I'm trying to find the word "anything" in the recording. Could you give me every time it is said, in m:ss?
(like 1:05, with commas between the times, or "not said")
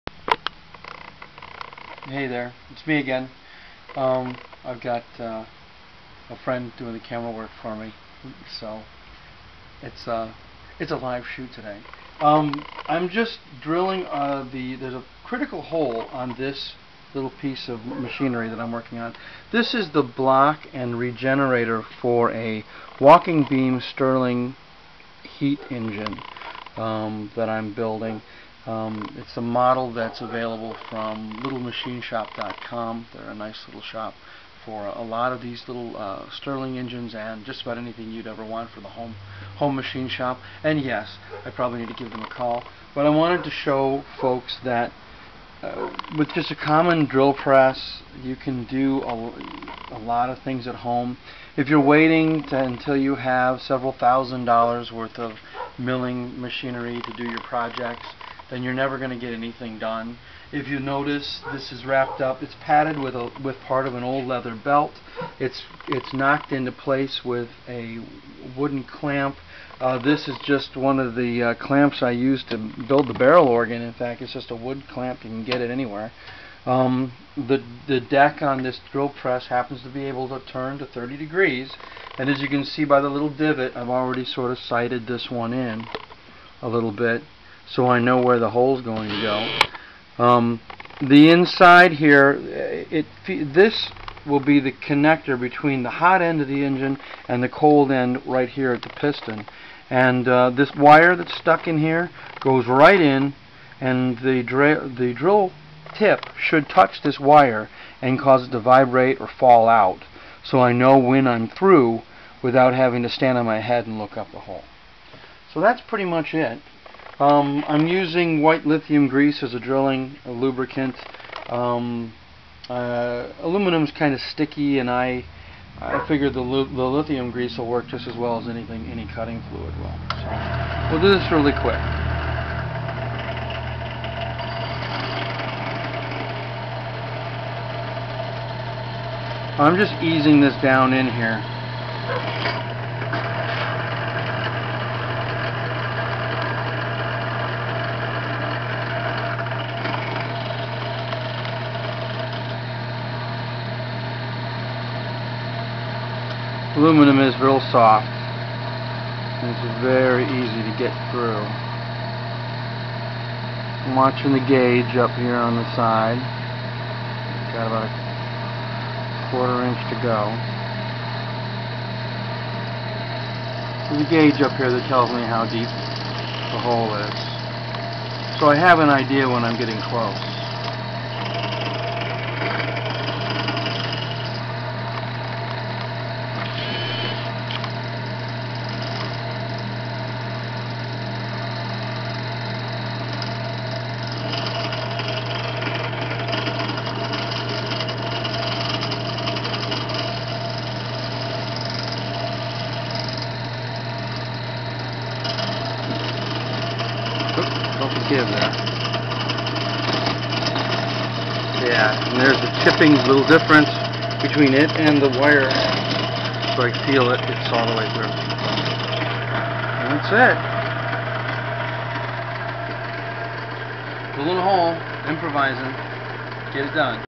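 0:37, 0:59, 2:08.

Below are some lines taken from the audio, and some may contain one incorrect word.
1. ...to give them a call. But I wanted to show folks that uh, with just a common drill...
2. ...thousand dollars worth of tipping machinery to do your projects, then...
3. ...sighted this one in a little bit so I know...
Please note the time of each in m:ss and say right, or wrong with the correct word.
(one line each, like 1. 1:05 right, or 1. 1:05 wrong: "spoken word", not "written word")
1. 0:41 right
2. 0:53 wrong: "milling", not "tipping"
3. 1:24 right.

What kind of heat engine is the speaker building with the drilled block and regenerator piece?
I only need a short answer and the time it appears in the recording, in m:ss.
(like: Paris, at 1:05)
Walking beam Stirling, at 0:22.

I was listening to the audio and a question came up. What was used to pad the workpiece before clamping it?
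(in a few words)
Leather belt.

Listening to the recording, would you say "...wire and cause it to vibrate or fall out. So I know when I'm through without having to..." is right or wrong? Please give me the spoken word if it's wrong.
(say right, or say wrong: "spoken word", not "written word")
right.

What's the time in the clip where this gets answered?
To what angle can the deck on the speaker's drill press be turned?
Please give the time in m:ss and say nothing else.
1:20.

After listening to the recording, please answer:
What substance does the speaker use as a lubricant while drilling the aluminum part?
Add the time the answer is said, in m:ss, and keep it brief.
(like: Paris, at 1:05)
White lithium grease, at 1:58.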